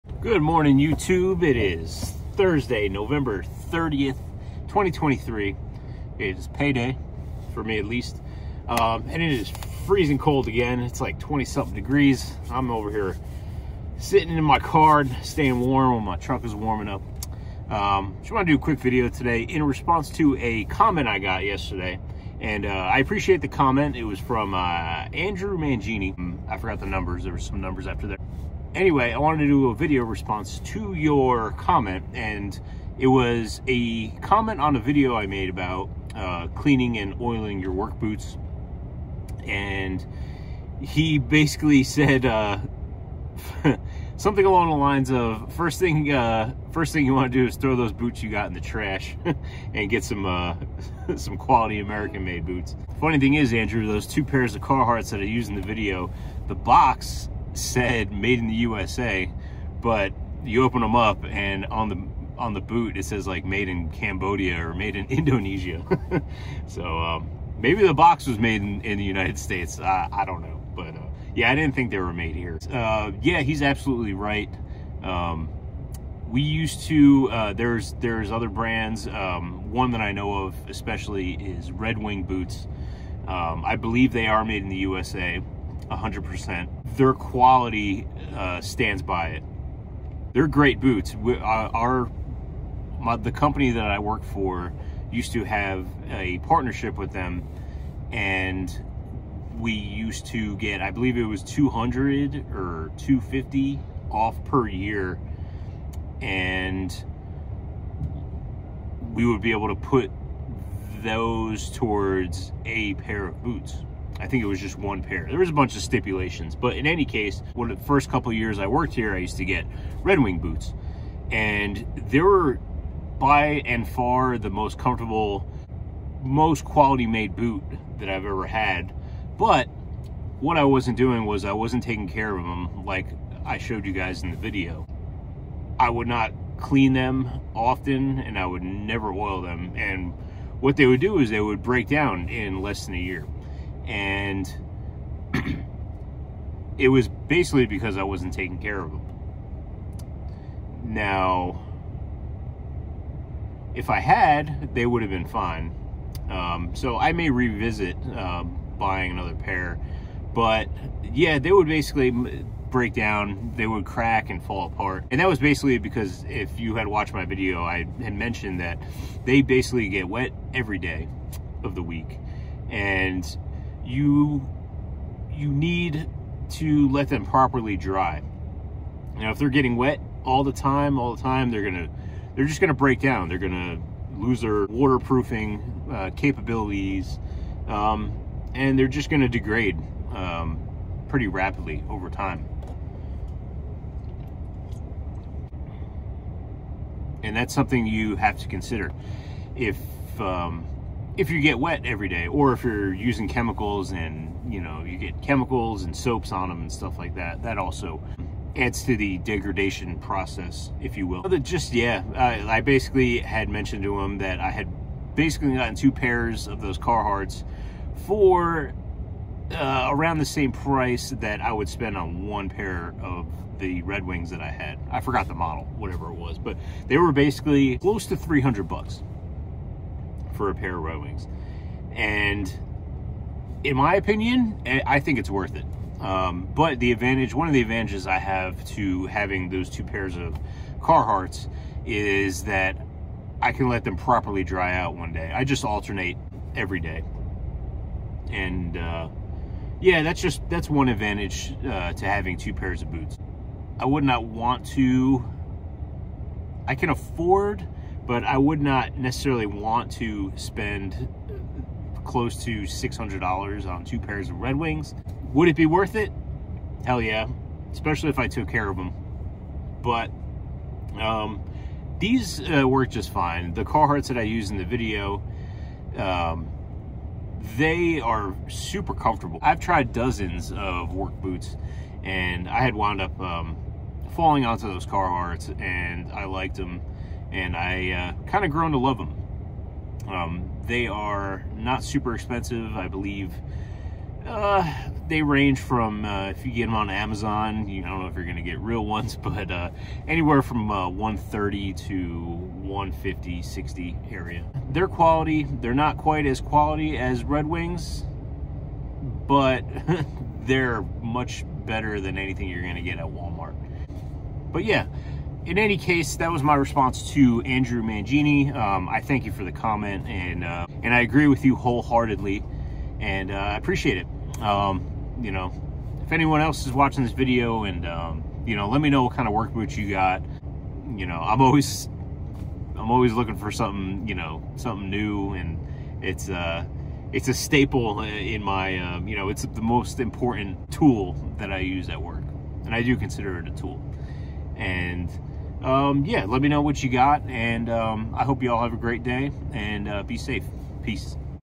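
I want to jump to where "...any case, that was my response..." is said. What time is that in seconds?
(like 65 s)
315 s.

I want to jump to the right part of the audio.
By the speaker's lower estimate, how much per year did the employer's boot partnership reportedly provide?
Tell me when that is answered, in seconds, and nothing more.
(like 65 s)
101 s.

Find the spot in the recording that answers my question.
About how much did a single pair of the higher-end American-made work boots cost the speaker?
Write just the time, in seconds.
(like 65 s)
228 s.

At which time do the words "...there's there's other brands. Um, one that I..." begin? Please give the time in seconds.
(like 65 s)
77 s.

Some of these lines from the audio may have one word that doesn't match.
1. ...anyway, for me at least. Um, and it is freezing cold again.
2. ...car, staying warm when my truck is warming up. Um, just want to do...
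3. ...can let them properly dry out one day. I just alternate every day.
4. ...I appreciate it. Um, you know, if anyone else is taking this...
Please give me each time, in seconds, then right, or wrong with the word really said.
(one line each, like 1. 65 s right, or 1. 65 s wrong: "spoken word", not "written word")
1. 6 s wrong: "payday", not "anyway"
2. 14 s right
3. 243 s right
4. 323 s wrong: "watching", not "taking".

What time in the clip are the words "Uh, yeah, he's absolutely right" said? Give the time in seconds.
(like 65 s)
72 s.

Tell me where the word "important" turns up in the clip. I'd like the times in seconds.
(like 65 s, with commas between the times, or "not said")
339 s.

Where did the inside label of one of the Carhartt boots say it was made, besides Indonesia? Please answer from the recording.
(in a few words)
Cambodia.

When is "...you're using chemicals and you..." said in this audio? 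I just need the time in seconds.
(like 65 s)
202 s.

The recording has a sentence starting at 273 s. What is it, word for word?
The Carhartts that I use in the video, um, they are super comfortable.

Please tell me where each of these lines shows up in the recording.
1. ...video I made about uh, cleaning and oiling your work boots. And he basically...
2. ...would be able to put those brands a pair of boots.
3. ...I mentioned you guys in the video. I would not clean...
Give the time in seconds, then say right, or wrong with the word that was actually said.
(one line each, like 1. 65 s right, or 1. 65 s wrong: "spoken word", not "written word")
1. 34 s right
2. 109 s wrong: "towards", not "brands"
3. 133 s wrong: "showed", not "mentioned".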